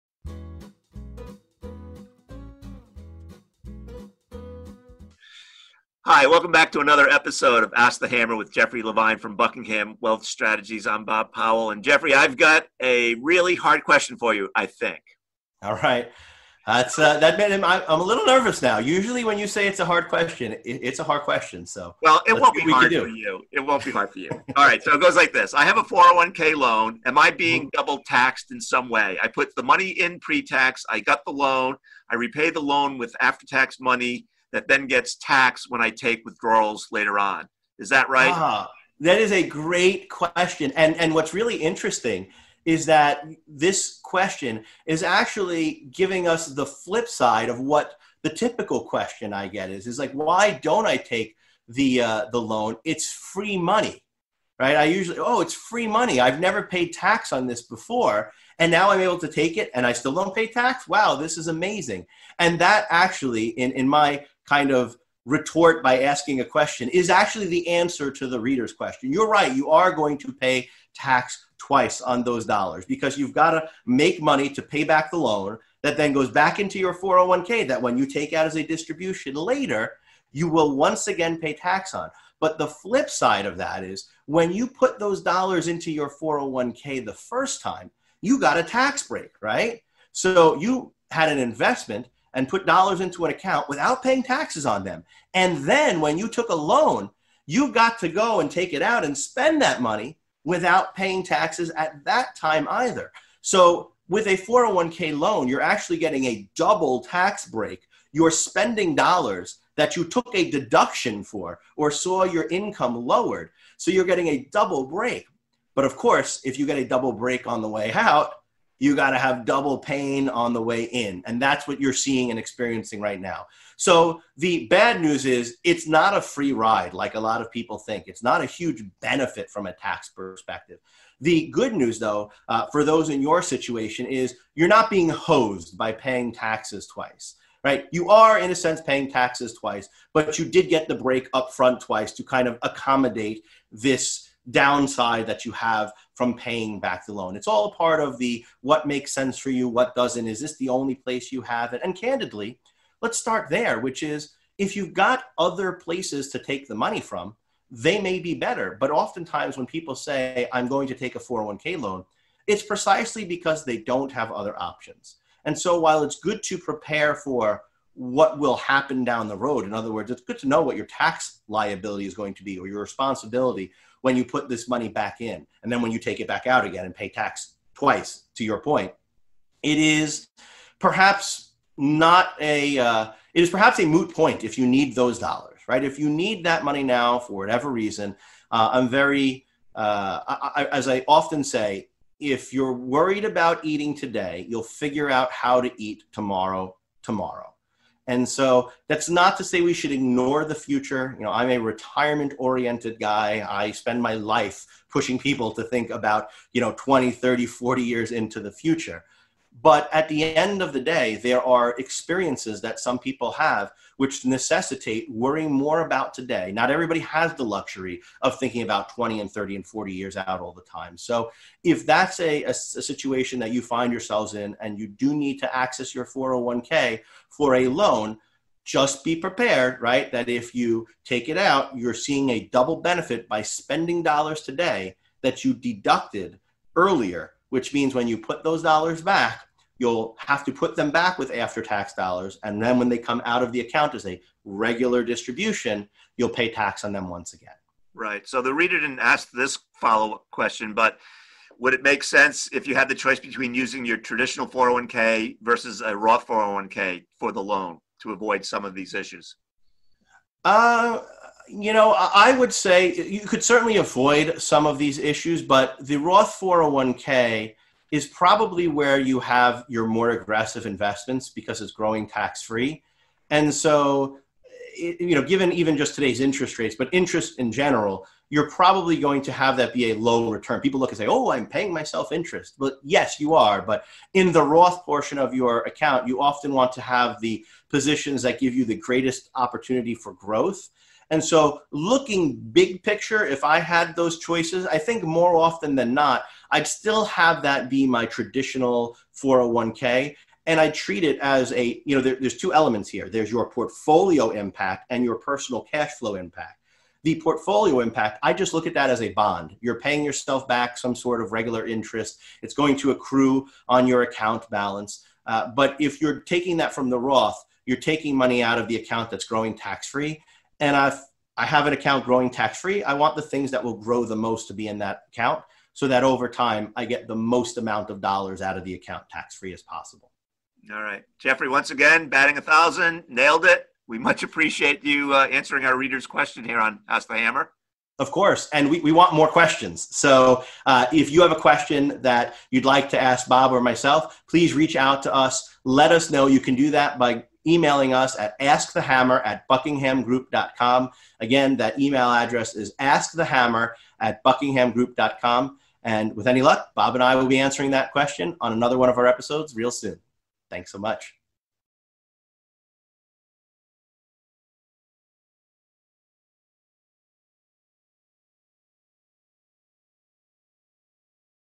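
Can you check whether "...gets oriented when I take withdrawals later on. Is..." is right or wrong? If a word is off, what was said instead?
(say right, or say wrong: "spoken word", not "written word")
wrong: "taxed", not "oriented".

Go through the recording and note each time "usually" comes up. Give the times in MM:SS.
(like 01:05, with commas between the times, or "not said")
00:18, 00:54.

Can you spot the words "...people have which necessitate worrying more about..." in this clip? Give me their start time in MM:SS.
03:32.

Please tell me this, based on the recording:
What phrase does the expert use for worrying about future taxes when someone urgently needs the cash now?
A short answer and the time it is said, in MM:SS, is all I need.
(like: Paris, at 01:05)
moot point, at 03:03.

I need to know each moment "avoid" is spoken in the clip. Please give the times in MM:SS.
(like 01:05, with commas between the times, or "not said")
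04:18, 04:23.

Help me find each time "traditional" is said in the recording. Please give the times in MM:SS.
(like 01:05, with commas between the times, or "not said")
04:13, 04:58.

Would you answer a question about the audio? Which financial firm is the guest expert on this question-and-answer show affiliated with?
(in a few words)
Buckingham Wealth Strategies.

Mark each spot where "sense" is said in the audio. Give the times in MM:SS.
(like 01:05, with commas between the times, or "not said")
02:18, 02:29, 04:12.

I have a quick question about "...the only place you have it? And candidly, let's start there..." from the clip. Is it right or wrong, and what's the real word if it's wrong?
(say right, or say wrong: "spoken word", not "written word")
right.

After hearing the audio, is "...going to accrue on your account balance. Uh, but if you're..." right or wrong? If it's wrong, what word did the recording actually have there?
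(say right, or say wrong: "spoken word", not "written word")
right.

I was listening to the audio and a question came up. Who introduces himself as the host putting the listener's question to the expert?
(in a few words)
Bob Powell.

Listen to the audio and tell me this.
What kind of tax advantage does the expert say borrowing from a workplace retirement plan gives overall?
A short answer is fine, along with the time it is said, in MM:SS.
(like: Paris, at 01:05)
double tax break, at 01:46.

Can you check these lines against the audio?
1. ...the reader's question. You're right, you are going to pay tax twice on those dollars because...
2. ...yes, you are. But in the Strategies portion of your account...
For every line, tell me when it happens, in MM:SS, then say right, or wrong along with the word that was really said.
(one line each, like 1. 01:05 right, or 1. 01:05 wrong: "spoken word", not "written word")
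1. 01:08 right
2. 04:42 wrong: "Roth", not "Strategies".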